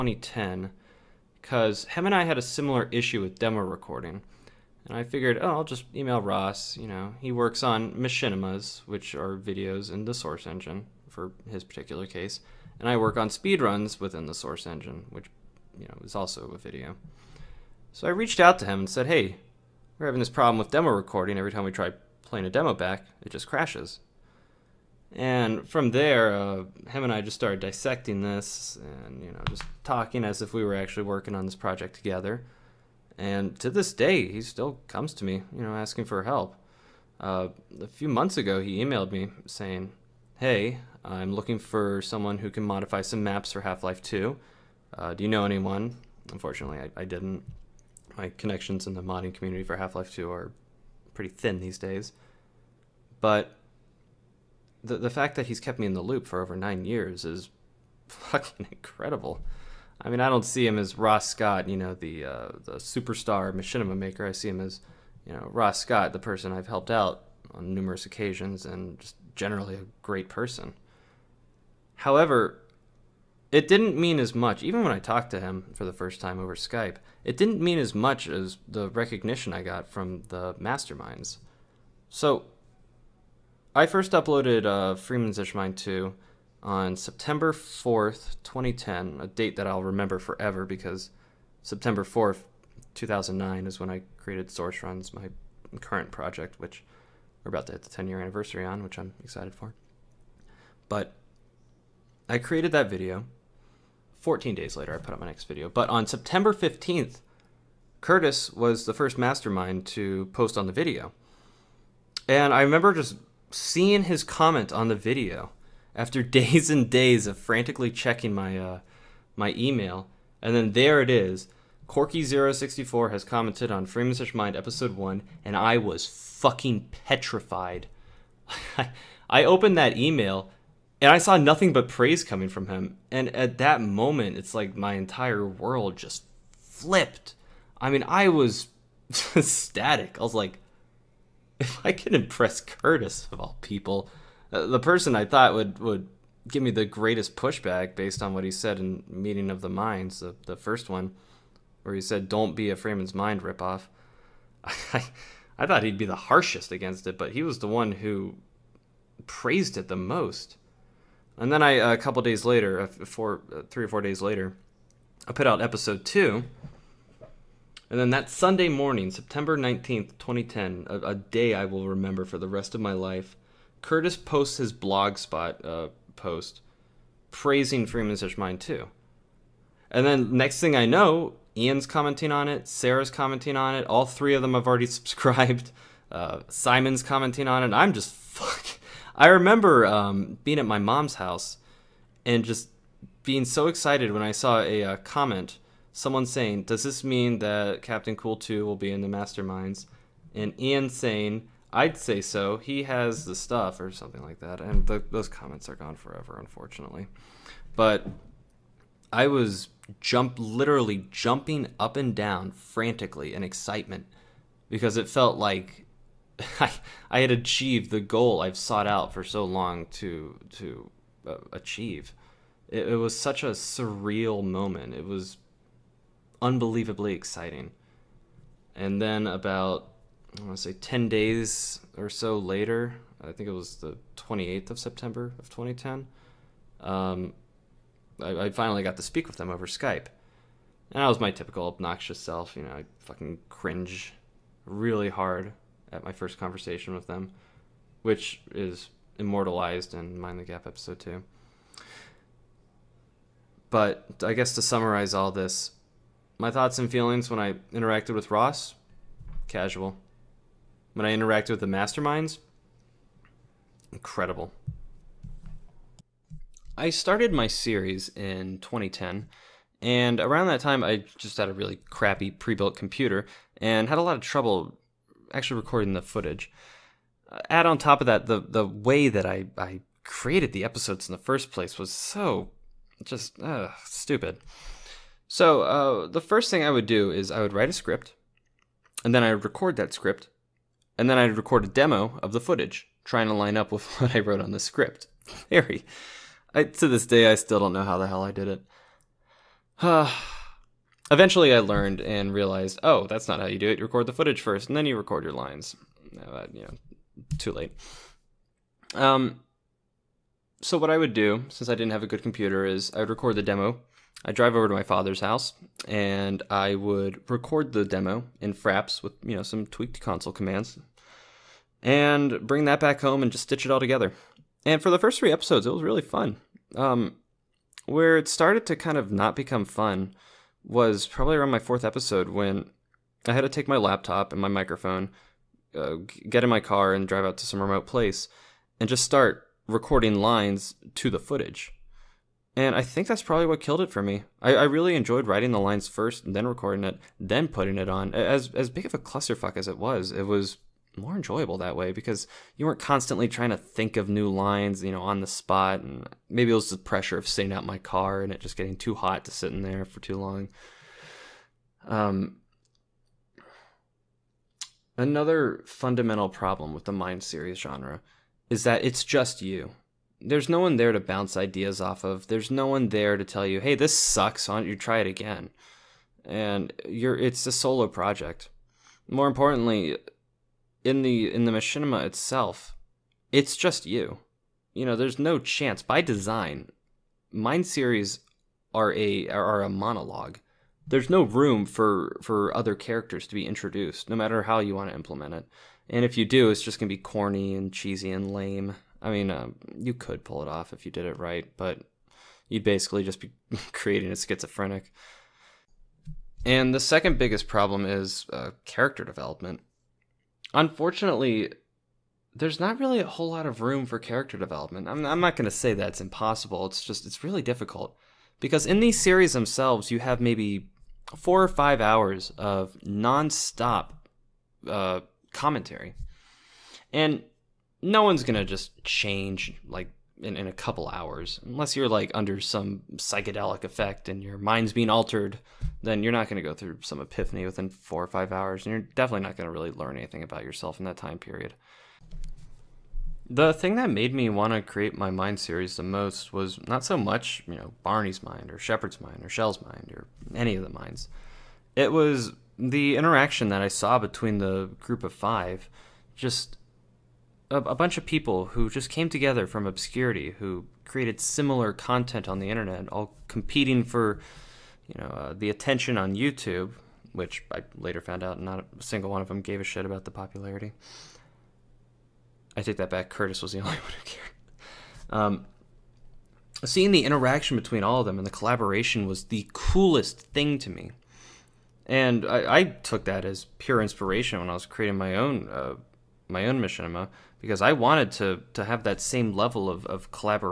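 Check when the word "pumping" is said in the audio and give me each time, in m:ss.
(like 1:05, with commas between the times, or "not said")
not said.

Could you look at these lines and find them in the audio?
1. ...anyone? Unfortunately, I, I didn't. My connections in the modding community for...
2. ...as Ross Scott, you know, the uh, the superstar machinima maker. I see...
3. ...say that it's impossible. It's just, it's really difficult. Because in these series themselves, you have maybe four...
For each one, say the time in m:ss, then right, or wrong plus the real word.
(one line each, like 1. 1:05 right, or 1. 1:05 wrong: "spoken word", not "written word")
1. 0:45 right
2. 1:00 right
3. 6:55 right.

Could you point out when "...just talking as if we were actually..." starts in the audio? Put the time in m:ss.
0:29.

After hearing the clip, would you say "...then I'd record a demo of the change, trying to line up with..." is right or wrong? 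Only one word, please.
wrong.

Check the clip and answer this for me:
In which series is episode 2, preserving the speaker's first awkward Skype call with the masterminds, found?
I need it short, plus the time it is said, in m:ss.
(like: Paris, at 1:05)
Mind the Gap, at 4:10.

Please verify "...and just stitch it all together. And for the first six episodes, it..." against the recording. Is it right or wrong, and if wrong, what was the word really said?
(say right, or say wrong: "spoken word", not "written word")
wrong: "three", not "six".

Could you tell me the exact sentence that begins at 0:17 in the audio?
So I reached out to him and said, hey, we're having this problem with demo recording.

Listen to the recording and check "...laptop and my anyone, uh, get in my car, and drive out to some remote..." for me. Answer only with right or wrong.
wrong.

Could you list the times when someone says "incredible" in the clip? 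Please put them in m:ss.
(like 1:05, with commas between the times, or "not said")
0:58, 4:23.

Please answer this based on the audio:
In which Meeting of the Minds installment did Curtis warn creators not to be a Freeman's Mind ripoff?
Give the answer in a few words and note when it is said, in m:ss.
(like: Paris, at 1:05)
the first one, at 2:30.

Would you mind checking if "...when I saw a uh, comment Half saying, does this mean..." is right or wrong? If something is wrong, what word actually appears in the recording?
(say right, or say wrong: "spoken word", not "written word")
wrong: "Someone", not "Half".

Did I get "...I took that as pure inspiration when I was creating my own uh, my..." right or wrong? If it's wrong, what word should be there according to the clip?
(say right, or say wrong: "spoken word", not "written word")
right.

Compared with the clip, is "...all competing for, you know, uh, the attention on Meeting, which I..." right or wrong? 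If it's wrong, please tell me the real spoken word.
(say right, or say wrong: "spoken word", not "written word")
wrong: "YouTube", not "Meeting".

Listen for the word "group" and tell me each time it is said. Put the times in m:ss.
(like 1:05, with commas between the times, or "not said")
7:34.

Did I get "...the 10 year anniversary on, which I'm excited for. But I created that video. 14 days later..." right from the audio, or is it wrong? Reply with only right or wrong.
right.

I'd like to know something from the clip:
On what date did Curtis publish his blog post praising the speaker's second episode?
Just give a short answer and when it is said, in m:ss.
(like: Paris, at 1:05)
September 19th, 2010, at 2:49.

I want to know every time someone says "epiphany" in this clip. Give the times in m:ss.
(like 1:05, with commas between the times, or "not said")
7:16.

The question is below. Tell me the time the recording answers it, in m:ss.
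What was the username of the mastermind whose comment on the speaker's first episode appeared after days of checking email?
2:01.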